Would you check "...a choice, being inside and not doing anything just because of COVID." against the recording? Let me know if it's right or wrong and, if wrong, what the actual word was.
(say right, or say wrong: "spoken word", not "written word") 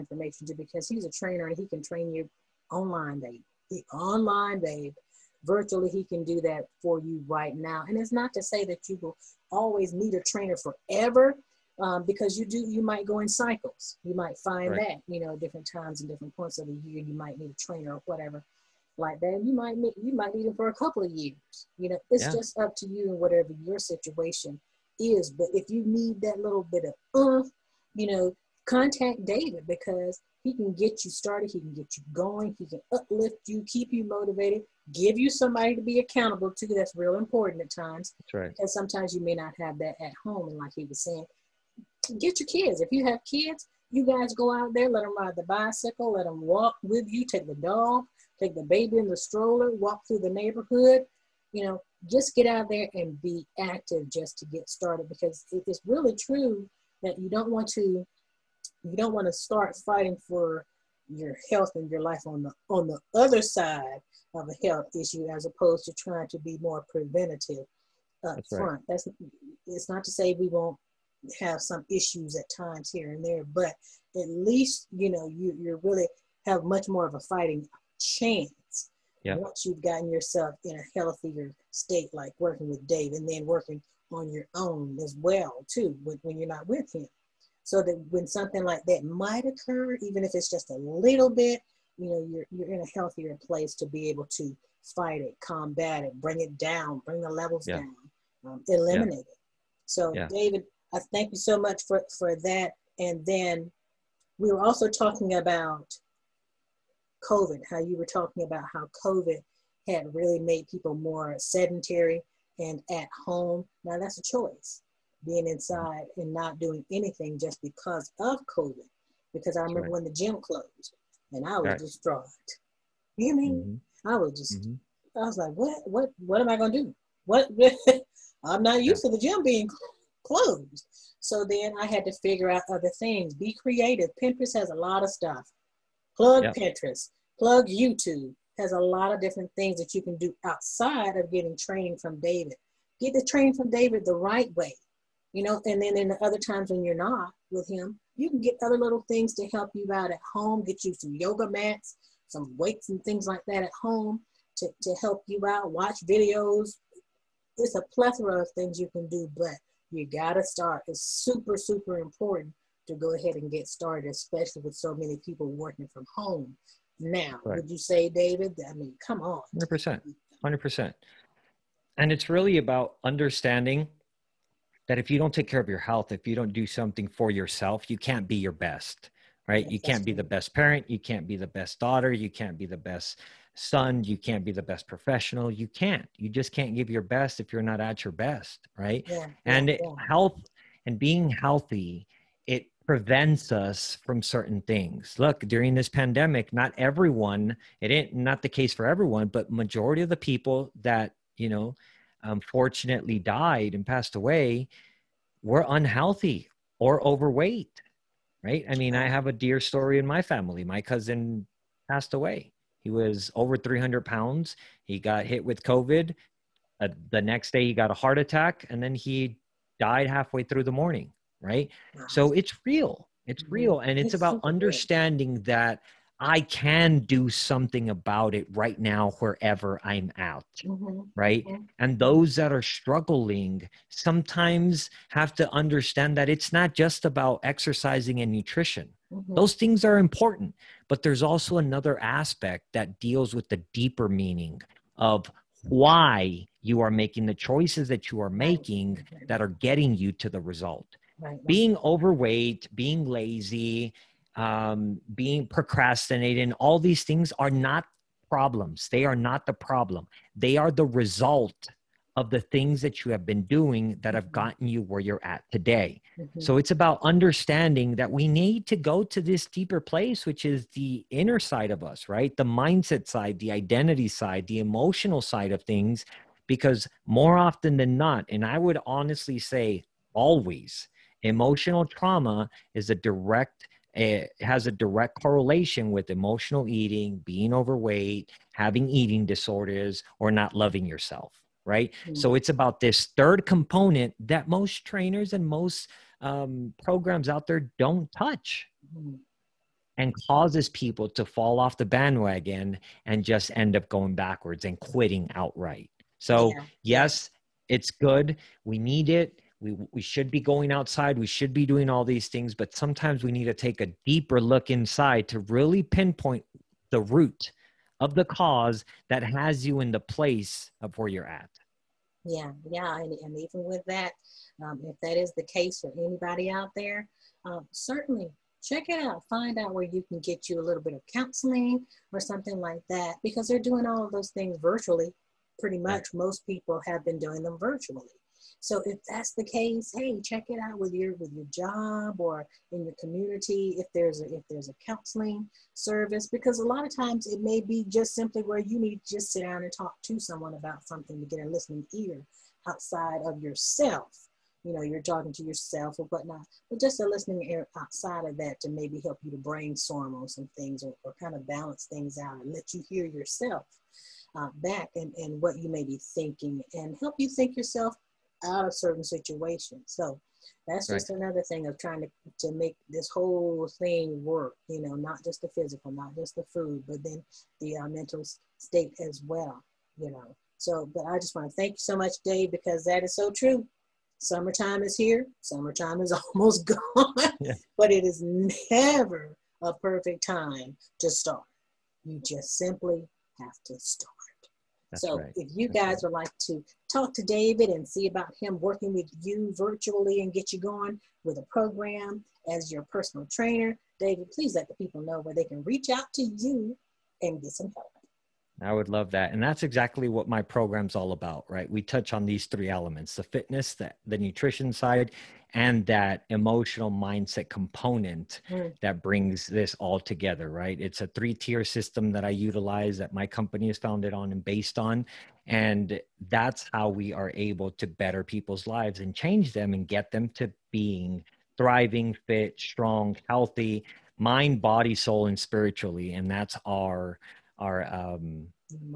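right.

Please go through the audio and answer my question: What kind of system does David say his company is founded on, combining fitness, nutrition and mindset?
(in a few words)
Three tier system.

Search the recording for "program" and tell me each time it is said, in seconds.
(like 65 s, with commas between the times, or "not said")
296 s, 401 s, 410 s.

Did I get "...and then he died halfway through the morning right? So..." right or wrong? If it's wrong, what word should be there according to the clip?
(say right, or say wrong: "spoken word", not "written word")
right.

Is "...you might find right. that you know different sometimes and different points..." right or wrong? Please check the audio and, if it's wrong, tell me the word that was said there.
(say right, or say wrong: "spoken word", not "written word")
wrong: "times", not "sometimes".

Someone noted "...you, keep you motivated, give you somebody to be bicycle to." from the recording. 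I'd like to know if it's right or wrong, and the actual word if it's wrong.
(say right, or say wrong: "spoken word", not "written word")
wrong: "accountable", not "bicycle".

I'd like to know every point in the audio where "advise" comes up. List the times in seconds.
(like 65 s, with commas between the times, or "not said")
not said.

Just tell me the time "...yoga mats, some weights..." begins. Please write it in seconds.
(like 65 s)
151 s.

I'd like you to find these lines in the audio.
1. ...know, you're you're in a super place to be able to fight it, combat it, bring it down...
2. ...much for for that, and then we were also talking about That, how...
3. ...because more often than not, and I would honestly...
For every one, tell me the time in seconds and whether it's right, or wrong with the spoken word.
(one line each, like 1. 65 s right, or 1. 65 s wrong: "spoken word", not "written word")
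1. 92 s wrong: "healthier", not "super"
2. 101 s wrong: "COVID", not "That"
3. 276 s right.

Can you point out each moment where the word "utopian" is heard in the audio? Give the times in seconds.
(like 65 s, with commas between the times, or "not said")
not said.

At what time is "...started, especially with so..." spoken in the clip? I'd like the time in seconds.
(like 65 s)
163 s.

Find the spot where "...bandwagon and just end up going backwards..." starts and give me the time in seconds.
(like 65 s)
301 s.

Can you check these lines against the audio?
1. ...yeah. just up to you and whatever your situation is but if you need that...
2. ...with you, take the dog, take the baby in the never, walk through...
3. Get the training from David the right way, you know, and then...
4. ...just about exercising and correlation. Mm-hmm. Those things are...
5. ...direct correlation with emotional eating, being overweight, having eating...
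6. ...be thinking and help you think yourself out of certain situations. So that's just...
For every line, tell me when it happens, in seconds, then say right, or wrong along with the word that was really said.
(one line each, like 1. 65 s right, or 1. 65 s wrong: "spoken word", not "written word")
1. 22 s right
2. 46 s wrong: "stroller", not "never"
3. 143 s right
4. 236 s wrong: "nutrition", not "correlation"
5. 284 s right
6. 365 s right.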